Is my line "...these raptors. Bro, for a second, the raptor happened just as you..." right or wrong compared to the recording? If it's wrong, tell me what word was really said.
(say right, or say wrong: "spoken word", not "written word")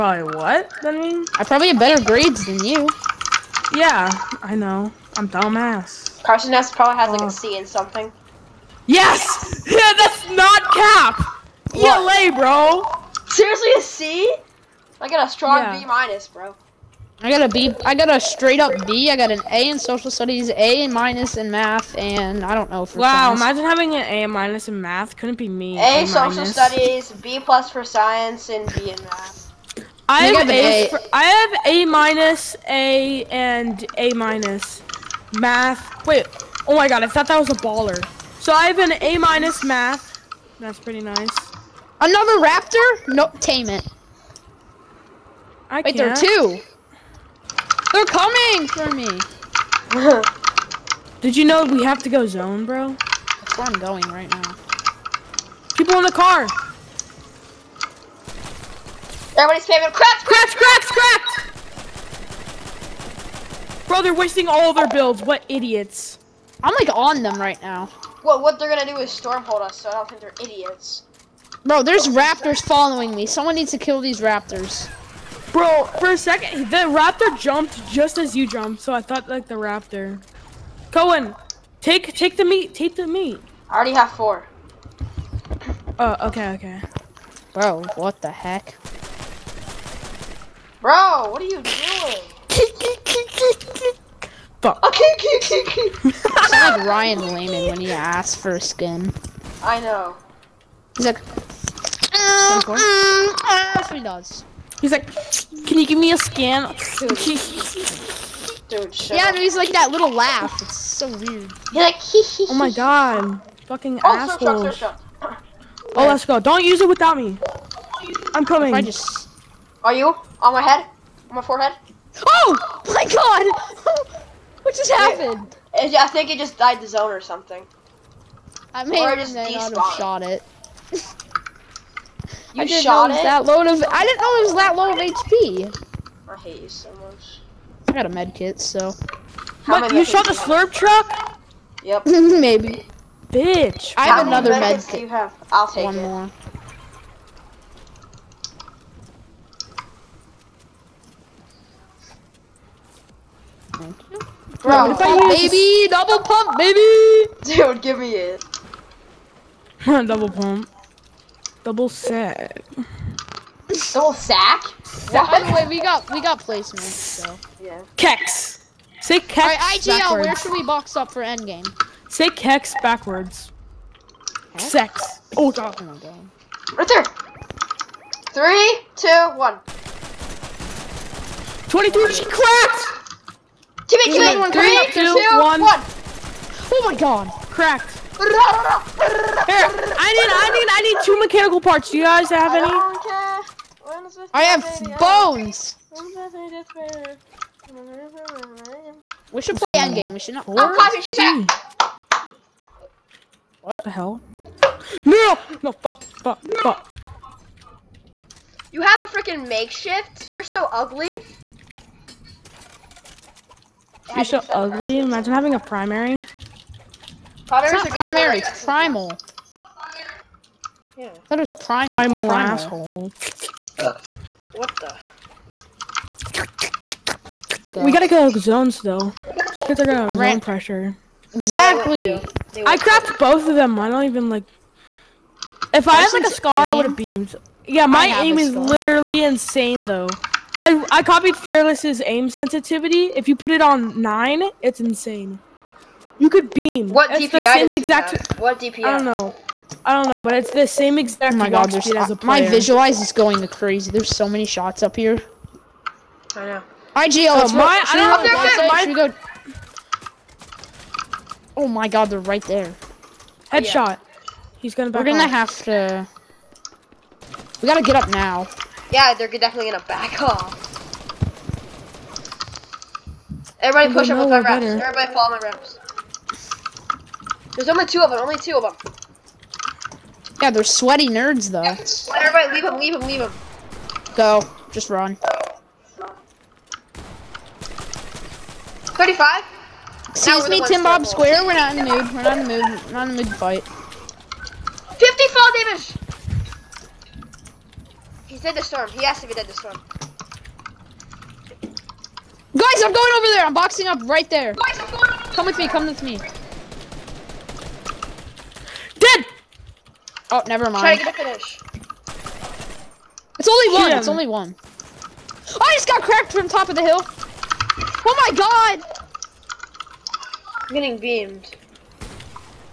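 wrong: "jumped", not "happened".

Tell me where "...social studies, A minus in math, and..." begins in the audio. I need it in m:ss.
0:19.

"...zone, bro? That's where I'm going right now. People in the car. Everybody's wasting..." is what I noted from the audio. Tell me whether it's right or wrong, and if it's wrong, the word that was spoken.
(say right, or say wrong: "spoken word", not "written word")
wrong: "spamming", not "wasting".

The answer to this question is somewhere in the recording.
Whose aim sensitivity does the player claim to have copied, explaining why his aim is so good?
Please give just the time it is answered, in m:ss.
4:01.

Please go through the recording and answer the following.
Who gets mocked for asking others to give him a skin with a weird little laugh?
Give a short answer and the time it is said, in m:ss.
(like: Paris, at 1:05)
Ryan Lehman, at 1:36.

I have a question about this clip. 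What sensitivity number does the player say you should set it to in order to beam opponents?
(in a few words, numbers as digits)
9.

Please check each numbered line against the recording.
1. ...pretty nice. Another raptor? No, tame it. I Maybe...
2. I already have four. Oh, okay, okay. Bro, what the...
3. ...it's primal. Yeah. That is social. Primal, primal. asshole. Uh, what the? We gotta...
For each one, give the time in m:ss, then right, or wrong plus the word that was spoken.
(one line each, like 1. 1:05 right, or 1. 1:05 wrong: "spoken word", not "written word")
1. 0:40 wrong: "Wait", not "Maybe"
2. 1:23 right
3. 3:38 wrong: "primal", not "social".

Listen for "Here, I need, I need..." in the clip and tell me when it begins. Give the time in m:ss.
3:08.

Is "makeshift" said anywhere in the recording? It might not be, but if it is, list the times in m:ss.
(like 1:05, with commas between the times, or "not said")
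3:29.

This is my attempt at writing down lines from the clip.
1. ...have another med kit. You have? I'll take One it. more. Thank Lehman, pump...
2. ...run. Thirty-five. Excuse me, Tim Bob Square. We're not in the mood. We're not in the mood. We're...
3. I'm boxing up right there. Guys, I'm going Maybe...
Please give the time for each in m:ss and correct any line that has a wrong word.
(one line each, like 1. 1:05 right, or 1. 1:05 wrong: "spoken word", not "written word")
1. 2:24 wrong: "Bro", not "Lehman"
2. 4:44 right
3. 5:03 wrong: "Come", not "Maybe".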